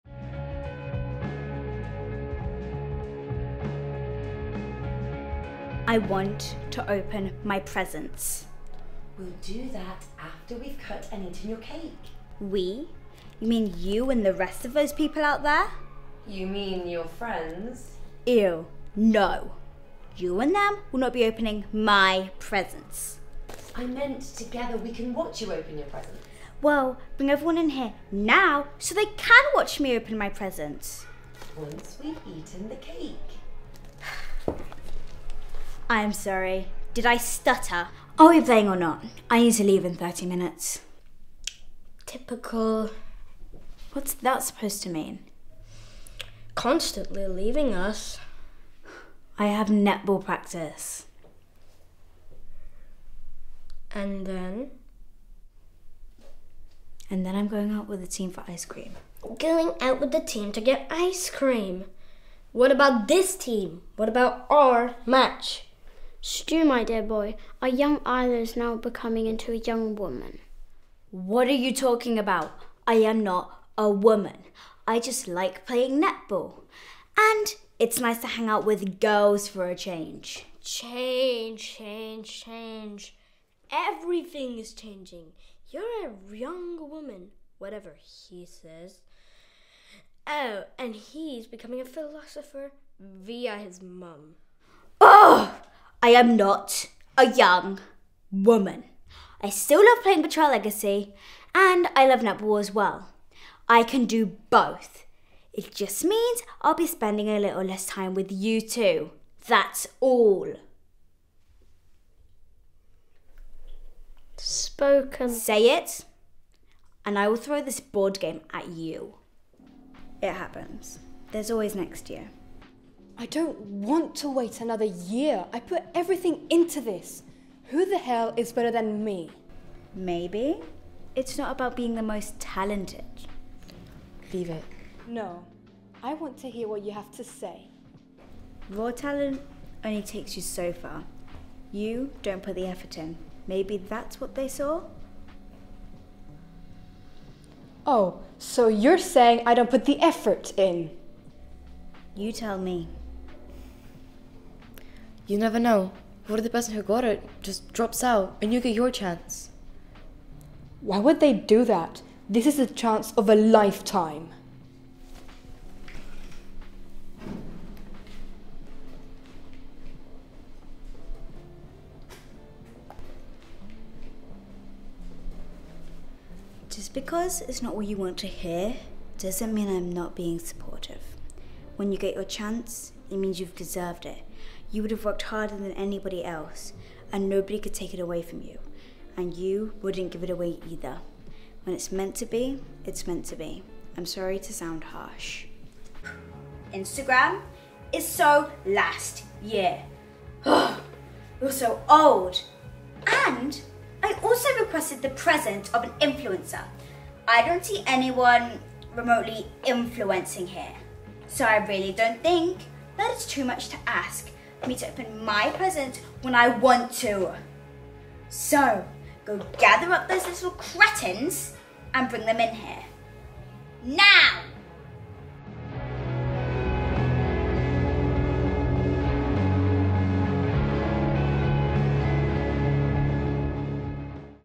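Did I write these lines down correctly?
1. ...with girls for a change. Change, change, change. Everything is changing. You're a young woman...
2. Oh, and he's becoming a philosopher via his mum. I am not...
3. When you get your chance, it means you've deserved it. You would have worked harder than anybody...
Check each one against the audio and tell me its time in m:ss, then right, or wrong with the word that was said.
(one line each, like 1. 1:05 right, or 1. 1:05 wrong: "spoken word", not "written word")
1. 1:18 right
2. 1:30 right
3. 3:01 right.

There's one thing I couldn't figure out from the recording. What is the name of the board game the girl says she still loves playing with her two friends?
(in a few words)
Betrayal Legacy.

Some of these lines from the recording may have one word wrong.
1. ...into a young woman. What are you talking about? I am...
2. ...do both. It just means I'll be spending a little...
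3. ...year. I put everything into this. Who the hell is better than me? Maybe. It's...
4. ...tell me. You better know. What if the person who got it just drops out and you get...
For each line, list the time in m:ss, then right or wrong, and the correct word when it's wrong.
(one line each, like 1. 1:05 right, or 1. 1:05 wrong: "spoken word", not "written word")
1. 1:09 right
2. 1:44 right
3. 2:04 right
4. 2:32 wrong: "never", not "better".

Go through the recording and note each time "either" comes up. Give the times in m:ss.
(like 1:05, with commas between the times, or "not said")
3:10.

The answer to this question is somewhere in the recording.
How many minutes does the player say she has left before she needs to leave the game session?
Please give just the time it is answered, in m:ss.
0:39.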